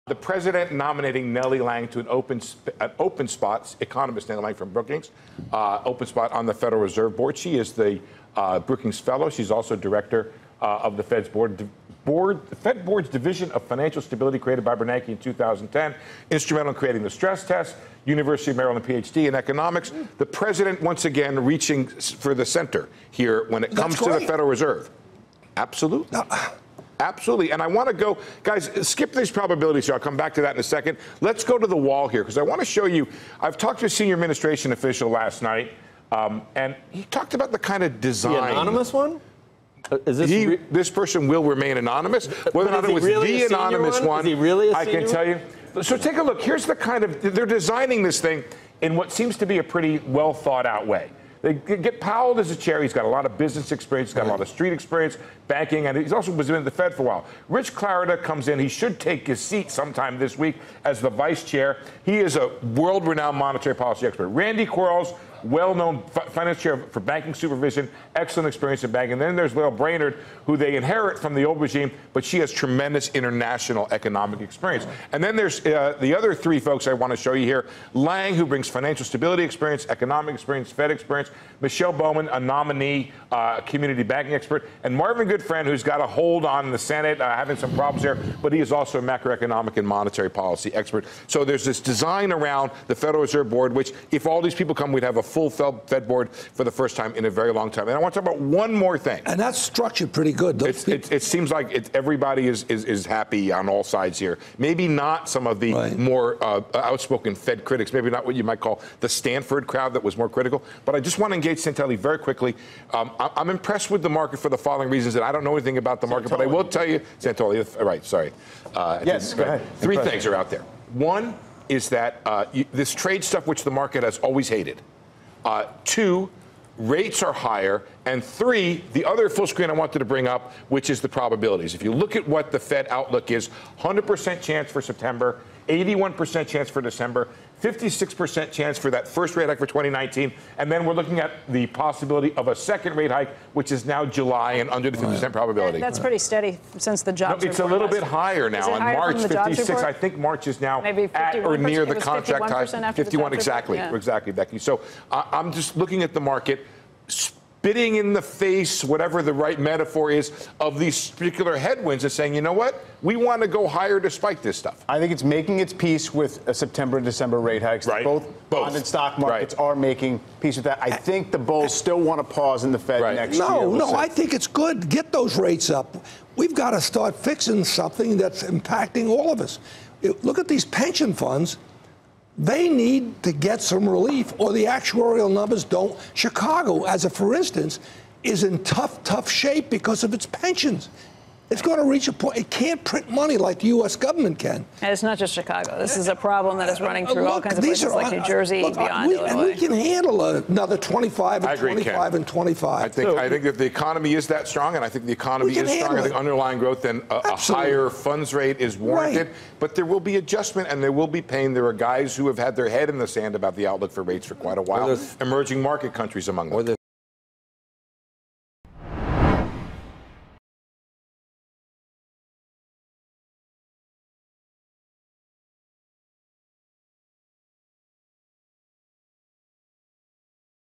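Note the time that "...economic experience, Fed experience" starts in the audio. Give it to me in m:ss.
1:19.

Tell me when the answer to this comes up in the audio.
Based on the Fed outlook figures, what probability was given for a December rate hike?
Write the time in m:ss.
2:15.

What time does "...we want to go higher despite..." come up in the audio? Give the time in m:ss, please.
2:43.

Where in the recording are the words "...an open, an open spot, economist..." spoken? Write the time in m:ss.
0:01.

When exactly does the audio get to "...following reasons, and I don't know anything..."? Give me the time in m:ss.
1:54.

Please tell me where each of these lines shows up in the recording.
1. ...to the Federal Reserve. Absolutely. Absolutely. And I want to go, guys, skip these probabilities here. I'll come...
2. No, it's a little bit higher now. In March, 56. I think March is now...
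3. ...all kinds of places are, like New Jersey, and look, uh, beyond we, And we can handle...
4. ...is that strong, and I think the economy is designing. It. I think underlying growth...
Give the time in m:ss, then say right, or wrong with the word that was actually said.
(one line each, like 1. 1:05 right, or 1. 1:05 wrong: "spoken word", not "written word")
1. 0:23 right
2. 2:27 right
3. 3:17 right
4. 3:24 wrong: "strong", not "designing".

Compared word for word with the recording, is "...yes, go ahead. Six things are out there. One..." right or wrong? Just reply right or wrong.
wrong.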